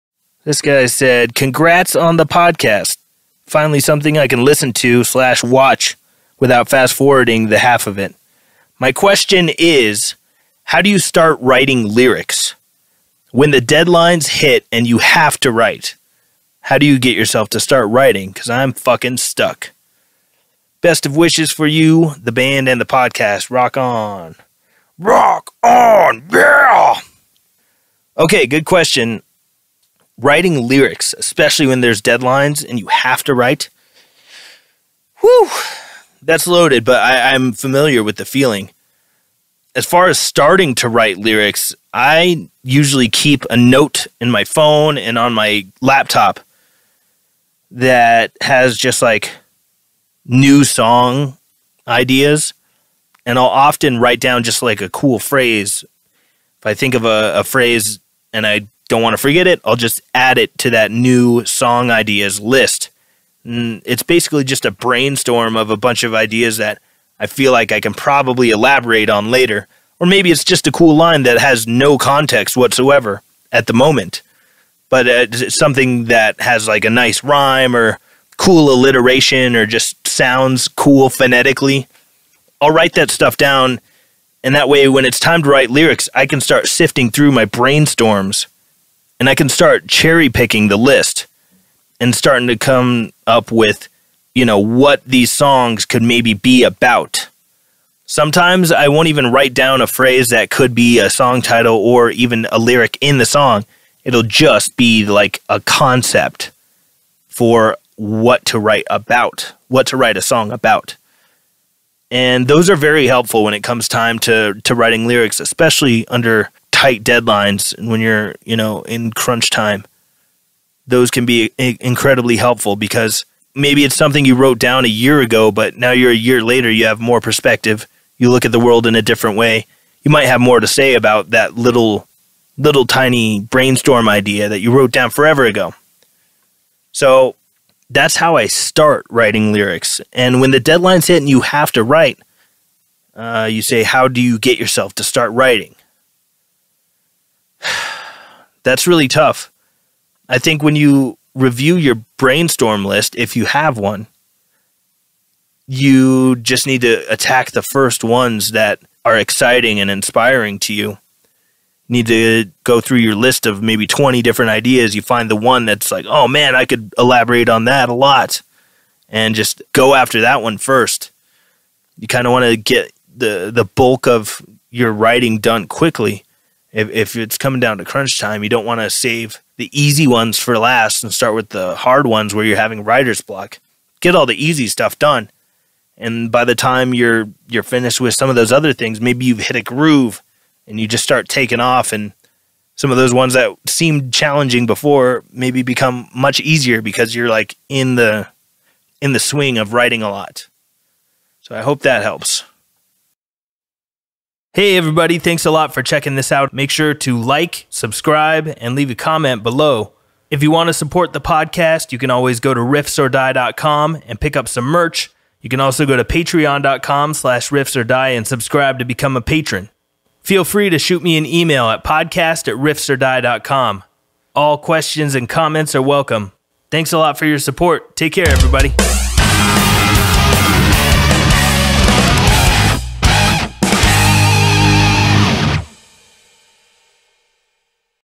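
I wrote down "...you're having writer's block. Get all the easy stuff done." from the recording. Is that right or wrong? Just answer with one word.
right.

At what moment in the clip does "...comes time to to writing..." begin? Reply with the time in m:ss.
1:53.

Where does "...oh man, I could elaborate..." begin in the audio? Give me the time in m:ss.
2:46.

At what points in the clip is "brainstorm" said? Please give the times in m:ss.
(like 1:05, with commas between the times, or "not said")
1:04, 1:27, 2:13, 2:32.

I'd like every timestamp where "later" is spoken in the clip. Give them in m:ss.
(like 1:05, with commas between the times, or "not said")
1:09, 2:06.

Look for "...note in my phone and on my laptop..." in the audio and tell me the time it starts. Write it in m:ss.
0:43.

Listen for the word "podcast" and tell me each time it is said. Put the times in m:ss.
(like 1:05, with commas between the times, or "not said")
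0:02, 0:22, 3:31, 3:41.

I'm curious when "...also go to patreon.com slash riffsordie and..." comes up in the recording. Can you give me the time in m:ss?
3:35.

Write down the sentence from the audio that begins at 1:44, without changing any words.
It'll just be like a concept for what to write about, what to write a song about.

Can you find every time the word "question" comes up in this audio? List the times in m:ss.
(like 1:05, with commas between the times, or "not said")
0:08, 0:28, 3:44.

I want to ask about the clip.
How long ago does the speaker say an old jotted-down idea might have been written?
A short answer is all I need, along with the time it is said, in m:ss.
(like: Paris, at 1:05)
a year ago, at 2:04.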